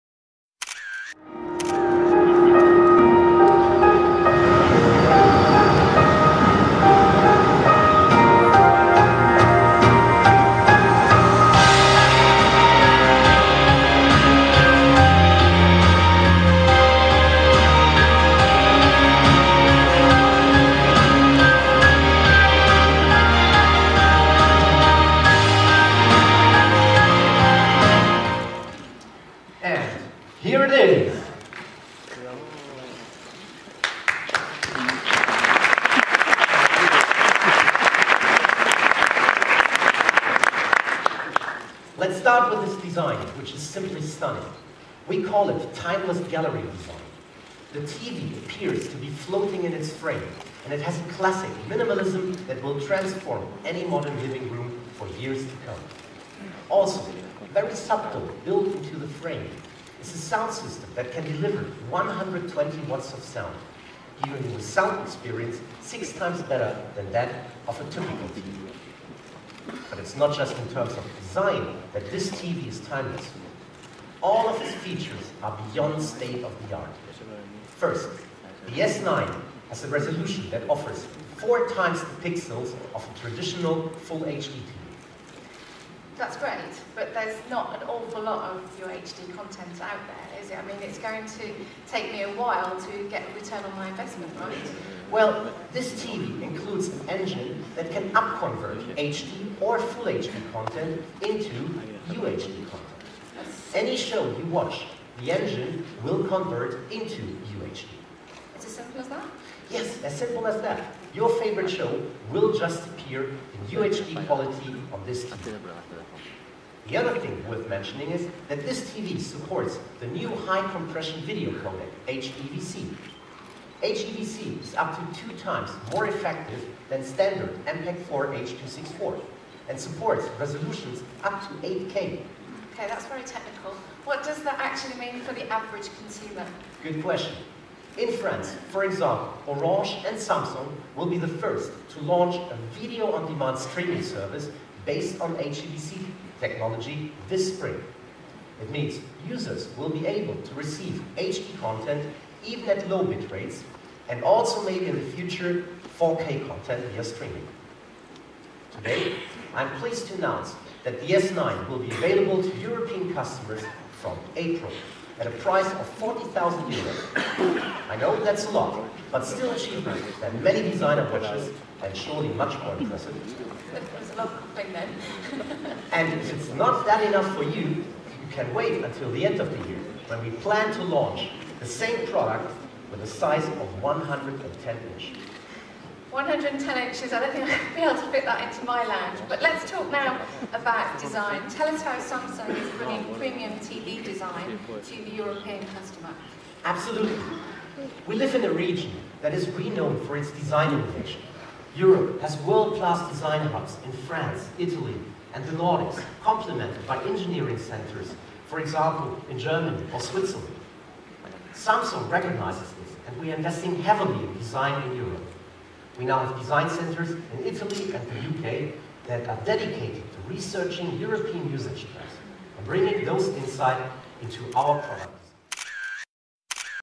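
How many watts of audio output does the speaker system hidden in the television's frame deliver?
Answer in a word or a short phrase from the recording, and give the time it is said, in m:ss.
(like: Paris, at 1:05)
120 watts, at 1:01.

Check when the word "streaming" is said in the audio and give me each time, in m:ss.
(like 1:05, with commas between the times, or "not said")
2:23, 2:37.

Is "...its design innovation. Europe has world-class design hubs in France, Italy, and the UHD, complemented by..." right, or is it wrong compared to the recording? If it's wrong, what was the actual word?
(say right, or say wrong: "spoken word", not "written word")
wrong: "Nordics", not "UHD".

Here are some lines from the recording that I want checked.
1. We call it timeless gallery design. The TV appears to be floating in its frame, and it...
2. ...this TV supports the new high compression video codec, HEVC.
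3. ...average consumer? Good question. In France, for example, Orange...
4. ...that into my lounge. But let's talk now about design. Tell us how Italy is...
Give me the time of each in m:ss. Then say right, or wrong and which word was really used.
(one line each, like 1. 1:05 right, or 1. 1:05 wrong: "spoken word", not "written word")
1. 0:45 right
2. 1:58 right
3. 2:15 right
4. 3:08 wrong: "Samsung", not "Italy".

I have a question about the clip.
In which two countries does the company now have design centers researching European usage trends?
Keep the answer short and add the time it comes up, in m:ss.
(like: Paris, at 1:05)
Italy and the UK, at 3:37.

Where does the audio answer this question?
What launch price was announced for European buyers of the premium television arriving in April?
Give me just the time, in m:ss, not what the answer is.
2:45.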